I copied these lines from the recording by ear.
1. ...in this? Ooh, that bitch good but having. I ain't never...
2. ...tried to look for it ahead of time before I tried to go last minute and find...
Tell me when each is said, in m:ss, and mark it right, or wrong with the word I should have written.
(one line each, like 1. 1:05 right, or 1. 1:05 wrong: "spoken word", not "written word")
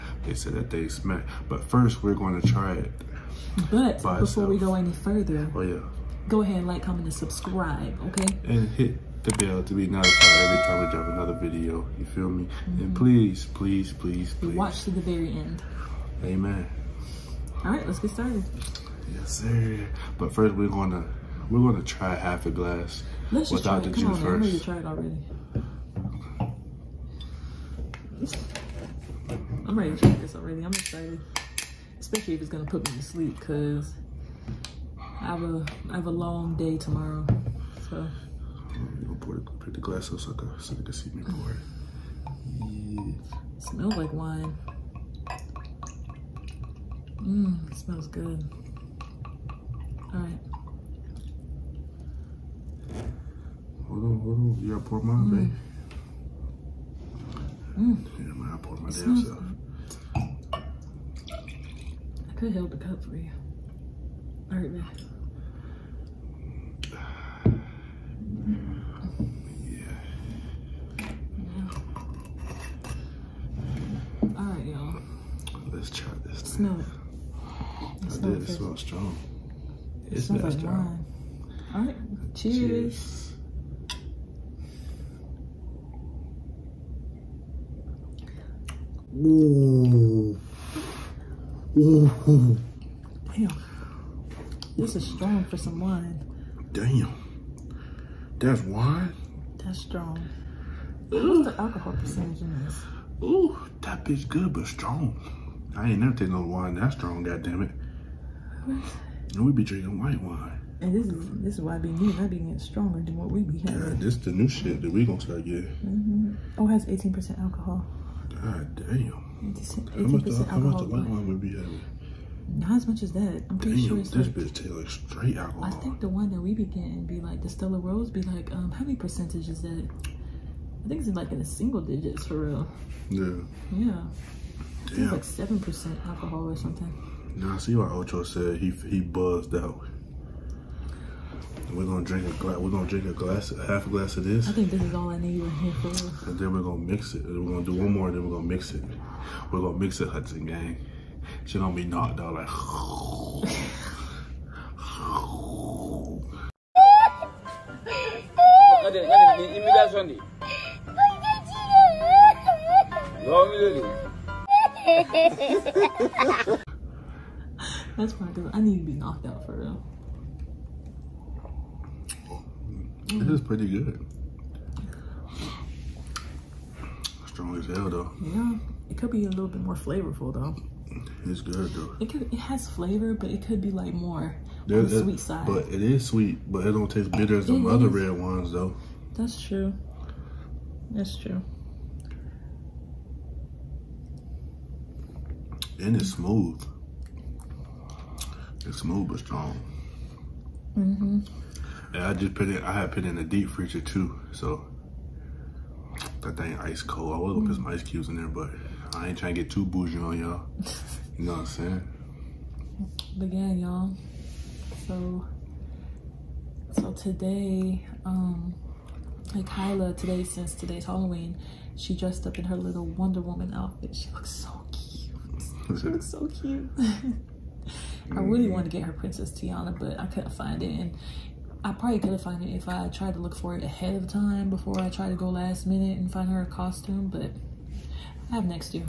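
1. 1:42 wrong: "strong", not "having"
2. 3:52 right.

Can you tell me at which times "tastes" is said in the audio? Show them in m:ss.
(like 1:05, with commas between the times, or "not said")
2:04, 3:06.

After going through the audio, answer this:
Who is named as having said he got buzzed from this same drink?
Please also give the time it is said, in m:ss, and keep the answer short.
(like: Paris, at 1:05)
Ocho, at 2:17.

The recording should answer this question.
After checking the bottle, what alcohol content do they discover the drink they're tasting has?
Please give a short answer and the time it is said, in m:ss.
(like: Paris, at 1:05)
18 percent, at 1:56.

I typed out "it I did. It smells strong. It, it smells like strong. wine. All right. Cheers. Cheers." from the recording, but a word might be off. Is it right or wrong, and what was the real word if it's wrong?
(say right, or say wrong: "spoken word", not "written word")
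right.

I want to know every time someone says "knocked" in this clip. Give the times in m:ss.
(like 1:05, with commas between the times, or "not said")
2:31, 2:48.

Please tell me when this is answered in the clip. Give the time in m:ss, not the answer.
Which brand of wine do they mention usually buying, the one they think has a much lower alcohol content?
2:07.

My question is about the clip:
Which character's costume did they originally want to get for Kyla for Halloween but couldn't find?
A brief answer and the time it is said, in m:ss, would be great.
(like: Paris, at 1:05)
Princess Tiana, at 3:48.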